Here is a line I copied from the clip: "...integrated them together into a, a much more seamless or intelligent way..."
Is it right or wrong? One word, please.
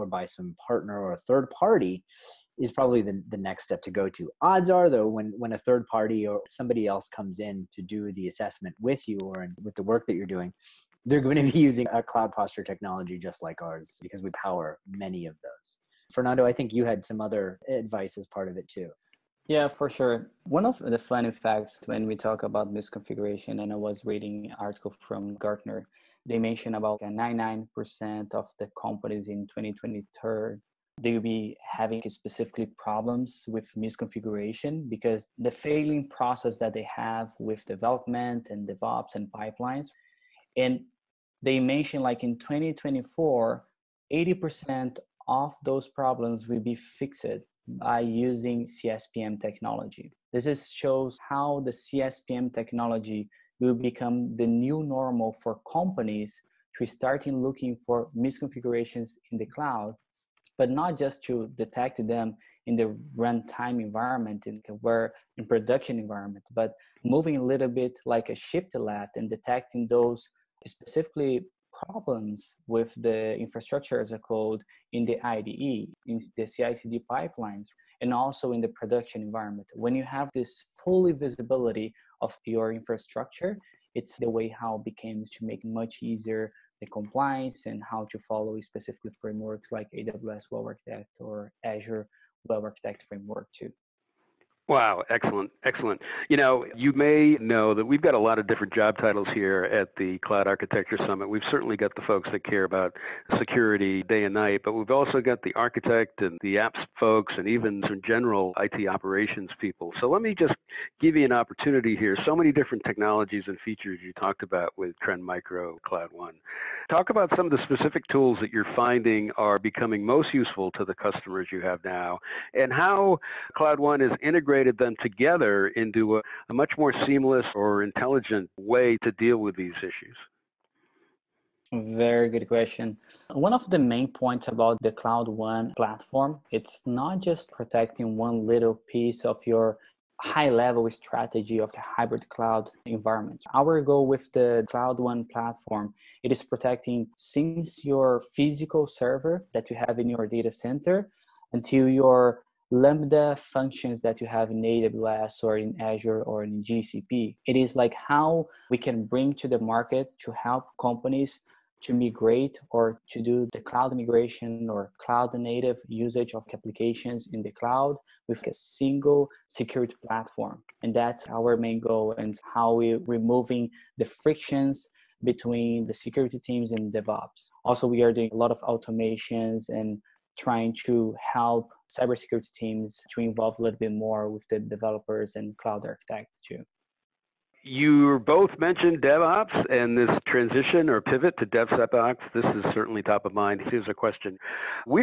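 right.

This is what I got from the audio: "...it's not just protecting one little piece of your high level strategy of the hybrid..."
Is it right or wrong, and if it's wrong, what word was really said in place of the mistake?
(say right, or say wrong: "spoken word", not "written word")
right.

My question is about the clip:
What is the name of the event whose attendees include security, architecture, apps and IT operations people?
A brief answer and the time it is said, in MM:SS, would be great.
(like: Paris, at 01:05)
Cloud Architecture Summit, at 01:40.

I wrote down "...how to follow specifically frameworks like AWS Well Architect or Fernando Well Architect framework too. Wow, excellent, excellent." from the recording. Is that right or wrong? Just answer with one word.
wrong.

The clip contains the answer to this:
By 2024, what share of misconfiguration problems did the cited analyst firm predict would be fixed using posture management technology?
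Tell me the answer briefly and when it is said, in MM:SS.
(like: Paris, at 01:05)
80%, at 00:44.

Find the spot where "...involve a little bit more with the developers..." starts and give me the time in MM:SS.
03:03.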